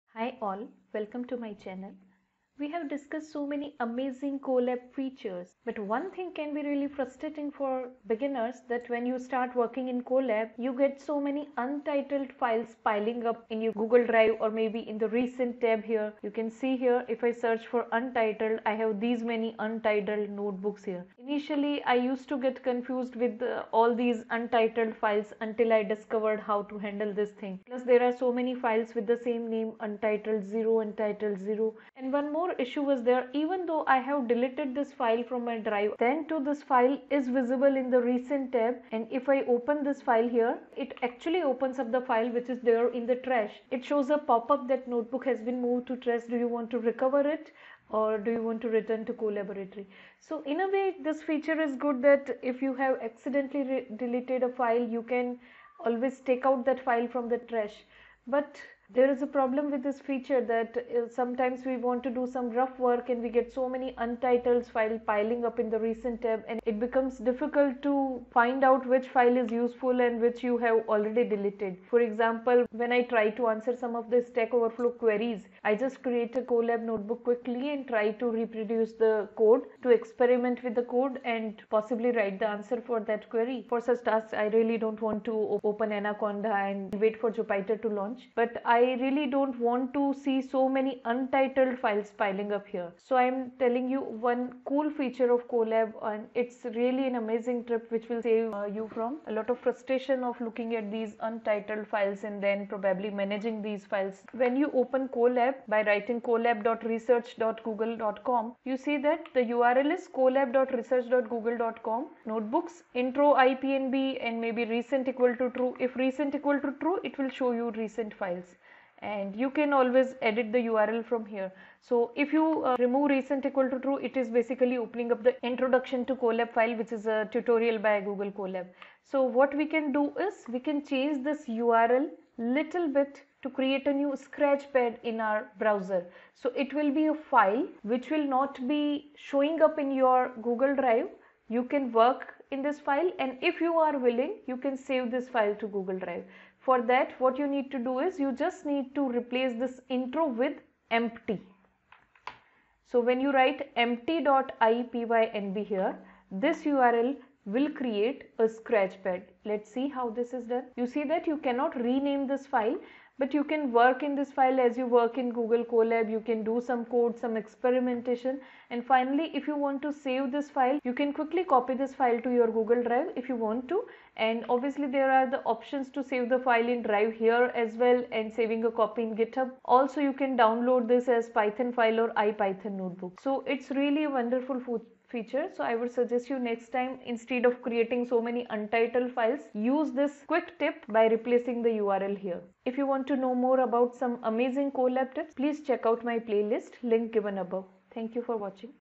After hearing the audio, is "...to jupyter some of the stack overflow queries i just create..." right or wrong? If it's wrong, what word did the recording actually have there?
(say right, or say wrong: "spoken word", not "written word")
wrong: "answer", not "jupyter".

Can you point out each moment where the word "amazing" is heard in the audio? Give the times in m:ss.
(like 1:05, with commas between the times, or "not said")
0:03, 1:37, 3:14.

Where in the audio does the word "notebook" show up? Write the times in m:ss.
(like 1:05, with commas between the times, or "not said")
0:20, 0:44, 1:16, 1:52, 3:02.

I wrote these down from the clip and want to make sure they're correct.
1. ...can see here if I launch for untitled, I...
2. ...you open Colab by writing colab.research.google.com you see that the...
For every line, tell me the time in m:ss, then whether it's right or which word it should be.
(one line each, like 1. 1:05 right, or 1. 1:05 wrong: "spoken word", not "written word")
1. 0:16 wrong: "search", not "launch"
2. 1:44 right.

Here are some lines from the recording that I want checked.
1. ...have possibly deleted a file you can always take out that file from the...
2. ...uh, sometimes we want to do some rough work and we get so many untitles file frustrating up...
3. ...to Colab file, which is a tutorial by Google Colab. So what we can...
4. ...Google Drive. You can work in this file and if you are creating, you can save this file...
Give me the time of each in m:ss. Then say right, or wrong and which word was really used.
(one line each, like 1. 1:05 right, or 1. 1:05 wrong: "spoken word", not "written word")
1. 0:52 wrong: "accidentally", not "possibly"
2. 1:00 wrong: "piling", not "frustrating"
3. 2:06 right
4. 2:20 wrong: "willing", not "creating".